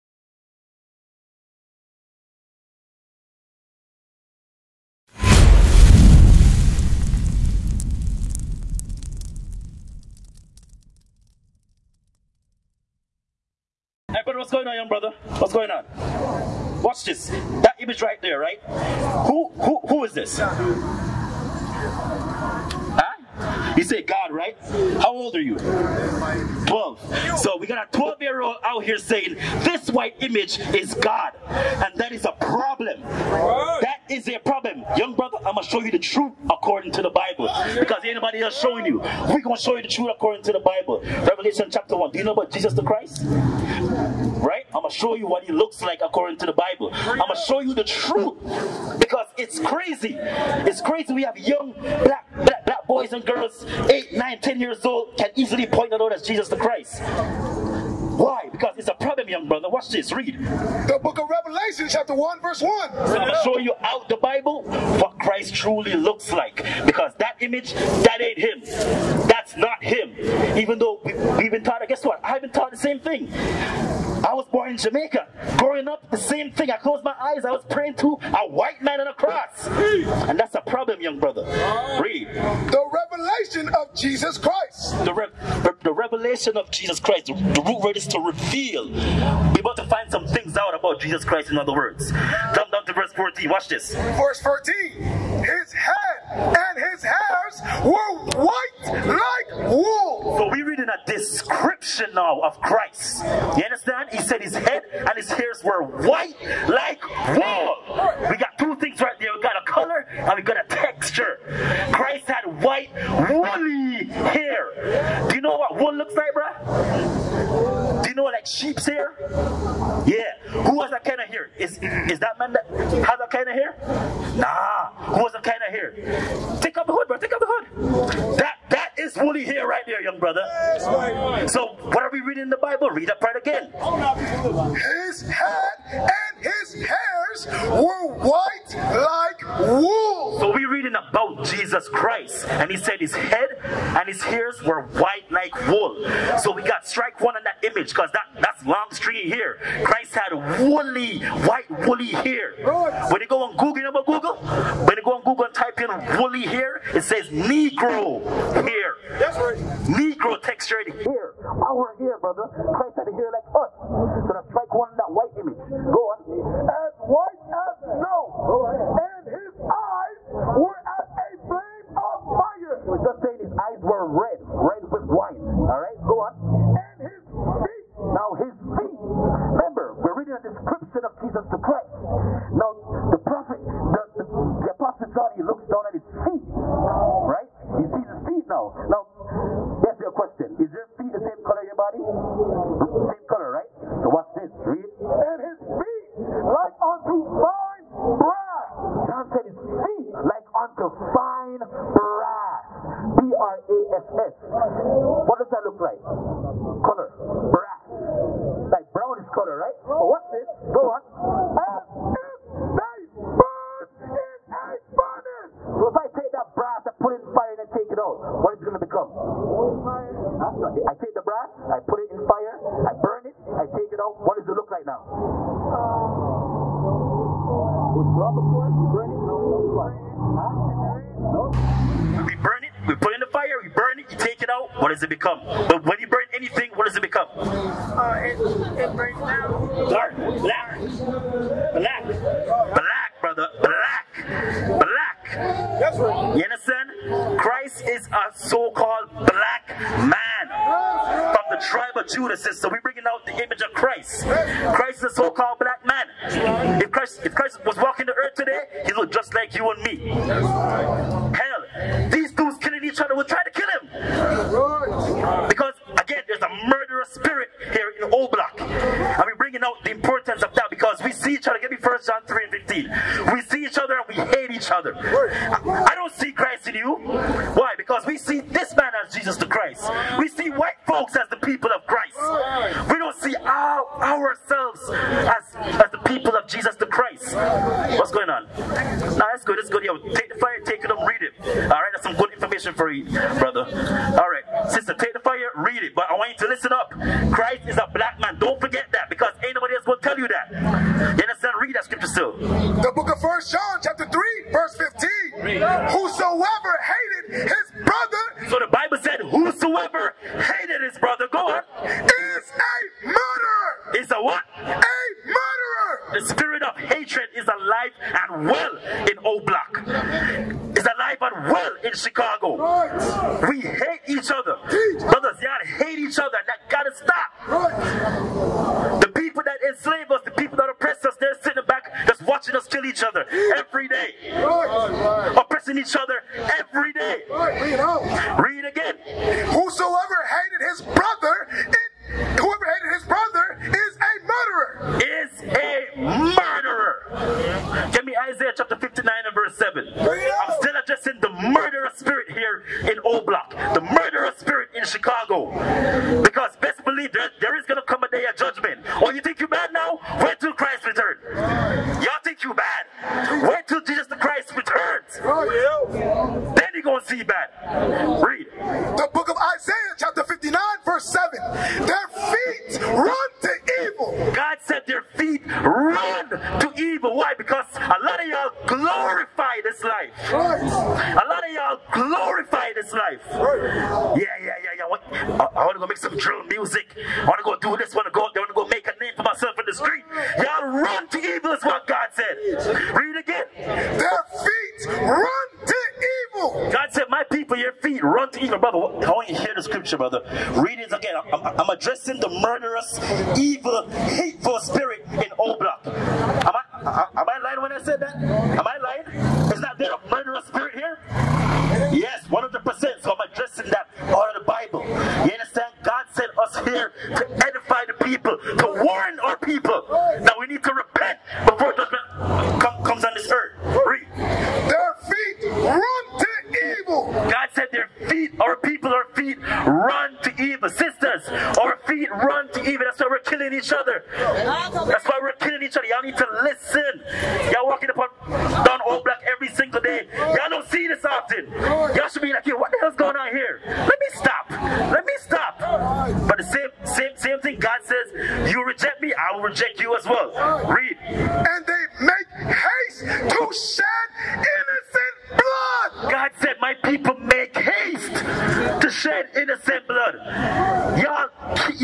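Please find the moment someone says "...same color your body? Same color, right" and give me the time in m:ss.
3:11.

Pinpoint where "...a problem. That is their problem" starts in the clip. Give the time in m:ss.
0:32.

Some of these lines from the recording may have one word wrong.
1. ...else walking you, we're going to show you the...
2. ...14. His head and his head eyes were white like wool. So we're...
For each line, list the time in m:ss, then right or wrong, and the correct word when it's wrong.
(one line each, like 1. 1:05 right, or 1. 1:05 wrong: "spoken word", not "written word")
1. 0:38 wrong: "showing", not "walking"
2. 1:34 right.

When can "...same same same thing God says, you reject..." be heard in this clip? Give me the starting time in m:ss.
7:26.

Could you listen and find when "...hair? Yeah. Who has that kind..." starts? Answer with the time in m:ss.
1:58.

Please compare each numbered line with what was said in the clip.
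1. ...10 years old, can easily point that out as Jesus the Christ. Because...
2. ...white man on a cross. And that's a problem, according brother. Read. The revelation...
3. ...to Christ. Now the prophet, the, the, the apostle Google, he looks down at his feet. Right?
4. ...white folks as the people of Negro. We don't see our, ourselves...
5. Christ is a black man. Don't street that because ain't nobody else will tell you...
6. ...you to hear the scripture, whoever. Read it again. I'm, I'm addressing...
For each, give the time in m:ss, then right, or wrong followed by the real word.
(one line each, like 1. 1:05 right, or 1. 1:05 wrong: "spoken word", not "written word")
1. 0:54 right
2. 1:18 wrong: "young", not "according"
3. 3:01 wrong: "John", not "Google"
4. 4:40 wrong: "Christ", not "Negro"
5. 4:57 wrong: "forget", not "street"
6. 6:39 wrong: "brother", not "whoever".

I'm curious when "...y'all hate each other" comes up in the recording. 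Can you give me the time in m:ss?
5:25.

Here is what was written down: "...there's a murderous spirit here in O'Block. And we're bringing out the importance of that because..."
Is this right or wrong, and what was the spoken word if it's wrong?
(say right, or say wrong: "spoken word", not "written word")
right.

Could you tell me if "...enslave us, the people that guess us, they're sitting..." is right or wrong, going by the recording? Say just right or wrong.
wrong.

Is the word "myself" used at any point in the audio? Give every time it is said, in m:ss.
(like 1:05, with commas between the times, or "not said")
6:29.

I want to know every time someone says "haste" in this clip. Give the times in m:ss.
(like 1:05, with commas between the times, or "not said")
7:32, 7:37.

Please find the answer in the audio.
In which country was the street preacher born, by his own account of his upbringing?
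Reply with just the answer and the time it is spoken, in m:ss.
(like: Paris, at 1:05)
Jamaica, at 1:14.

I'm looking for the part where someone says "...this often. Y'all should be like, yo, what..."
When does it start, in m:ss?
7:20.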